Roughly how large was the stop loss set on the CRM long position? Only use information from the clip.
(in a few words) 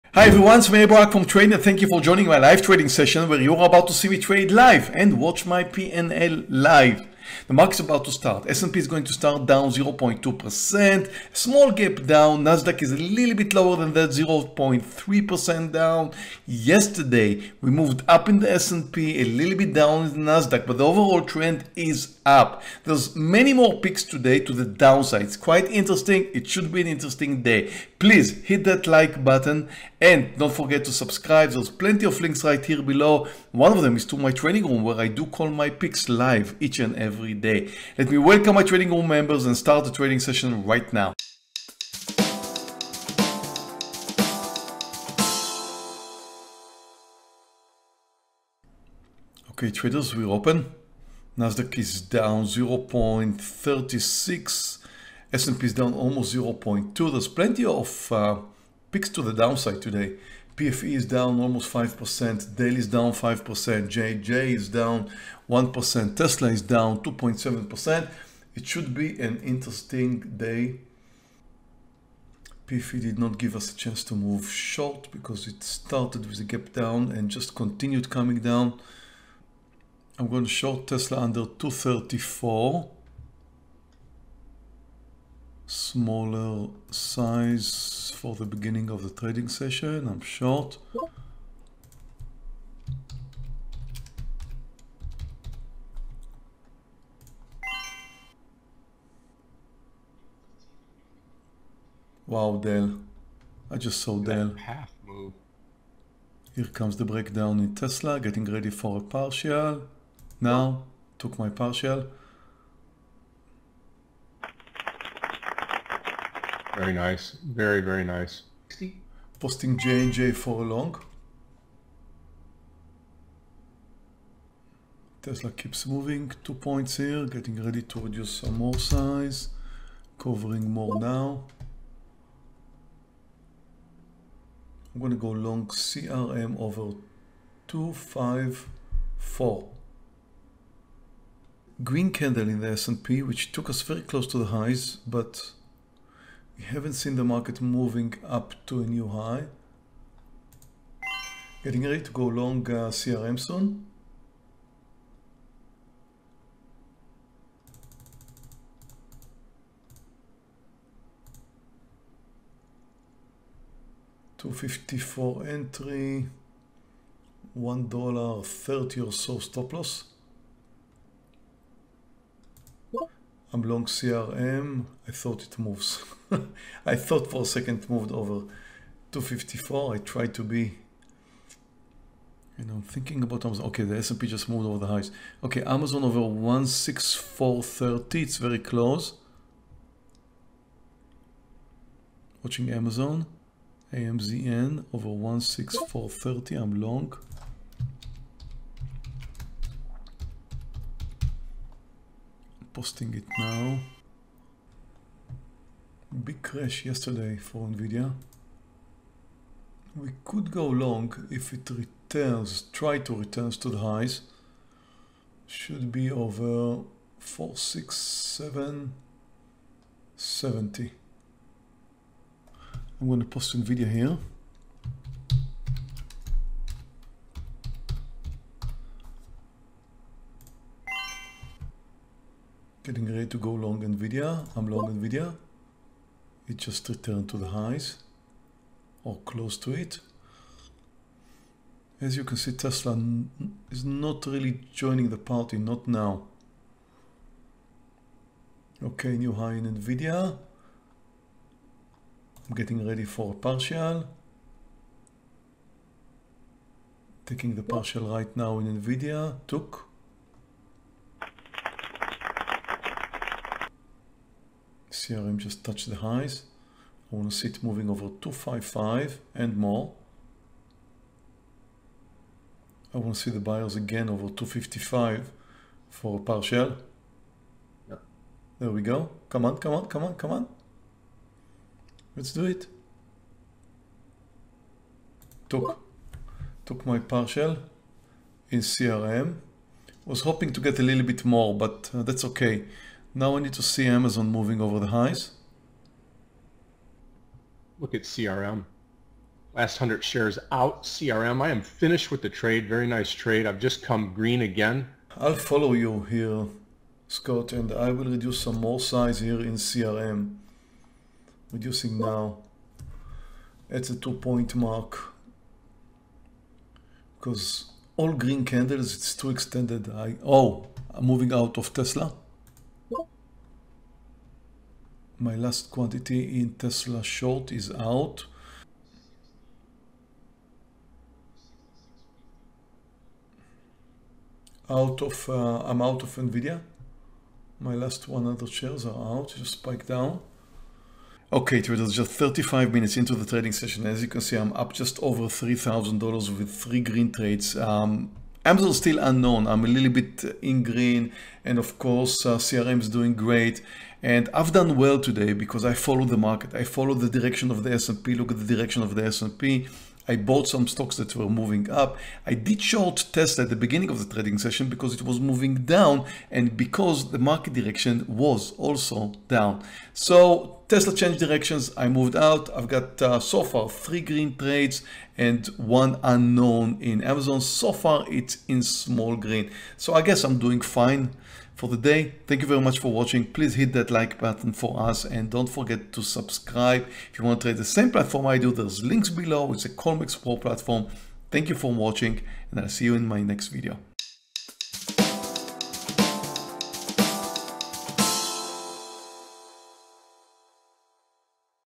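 $1.30.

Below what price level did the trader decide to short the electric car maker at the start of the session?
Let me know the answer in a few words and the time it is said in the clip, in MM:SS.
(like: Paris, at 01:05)
234, at 01:21.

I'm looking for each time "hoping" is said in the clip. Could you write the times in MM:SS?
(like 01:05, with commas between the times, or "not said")
04:50.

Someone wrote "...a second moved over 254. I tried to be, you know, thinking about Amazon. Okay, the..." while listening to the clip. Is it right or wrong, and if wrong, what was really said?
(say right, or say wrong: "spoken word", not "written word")
right.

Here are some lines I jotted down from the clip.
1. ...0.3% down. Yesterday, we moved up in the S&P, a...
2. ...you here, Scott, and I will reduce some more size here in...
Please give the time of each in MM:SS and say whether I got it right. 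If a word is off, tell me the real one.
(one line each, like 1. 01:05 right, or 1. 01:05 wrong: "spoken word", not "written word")
1. 00:14 right
2. 05:05 right.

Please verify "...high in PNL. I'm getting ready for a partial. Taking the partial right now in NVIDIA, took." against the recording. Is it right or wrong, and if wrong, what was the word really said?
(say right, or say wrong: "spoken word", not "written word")
wrong: "NVIDIA", not "PNL".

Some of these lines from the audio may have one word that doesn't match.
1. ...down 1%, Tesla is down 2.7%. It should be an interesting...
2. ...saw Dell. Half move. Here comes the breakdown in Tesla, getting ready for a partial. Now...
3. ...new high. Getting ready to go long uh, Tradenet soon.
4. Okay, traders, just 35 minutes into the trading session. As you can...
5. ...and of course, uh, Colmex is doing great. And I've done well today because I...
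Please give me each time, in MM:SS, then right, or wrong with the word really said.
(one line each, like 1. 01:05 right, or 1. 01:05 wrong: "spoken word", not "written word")
1. 01:04 right
2. 01:44 right
3. 02:28 wrong: "CRM", not "Tradenet"
4. 05:41 right
5. 05:51 wrong: "CRM", not "Colmex".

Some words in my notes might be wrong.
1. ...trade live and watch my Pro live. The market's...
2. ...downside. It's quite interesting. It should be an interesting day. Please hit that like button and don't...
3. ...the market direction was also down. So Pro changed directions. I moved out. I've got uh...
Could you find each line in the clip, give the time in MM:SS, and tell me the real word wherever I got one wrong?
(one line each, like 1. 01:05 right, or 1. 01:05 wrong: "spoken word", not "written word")
1. 00:04 wrong: "PNL", not "Pro"
2. 00:24 right
3. 06:07 wrong: "Tesla", not "Pro".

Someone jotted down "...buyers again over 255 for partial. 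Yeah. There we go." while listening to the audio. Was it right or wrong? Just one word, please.
right.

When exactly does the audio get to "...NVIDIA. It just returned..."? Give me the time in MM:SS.
03:54.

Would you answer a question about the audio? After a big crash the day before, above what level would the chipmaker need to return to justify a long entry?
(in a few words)
467.70.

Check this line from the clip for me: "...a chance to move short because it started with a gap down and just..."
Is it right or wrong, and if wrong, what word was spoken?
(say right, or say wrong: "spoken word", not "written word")
right.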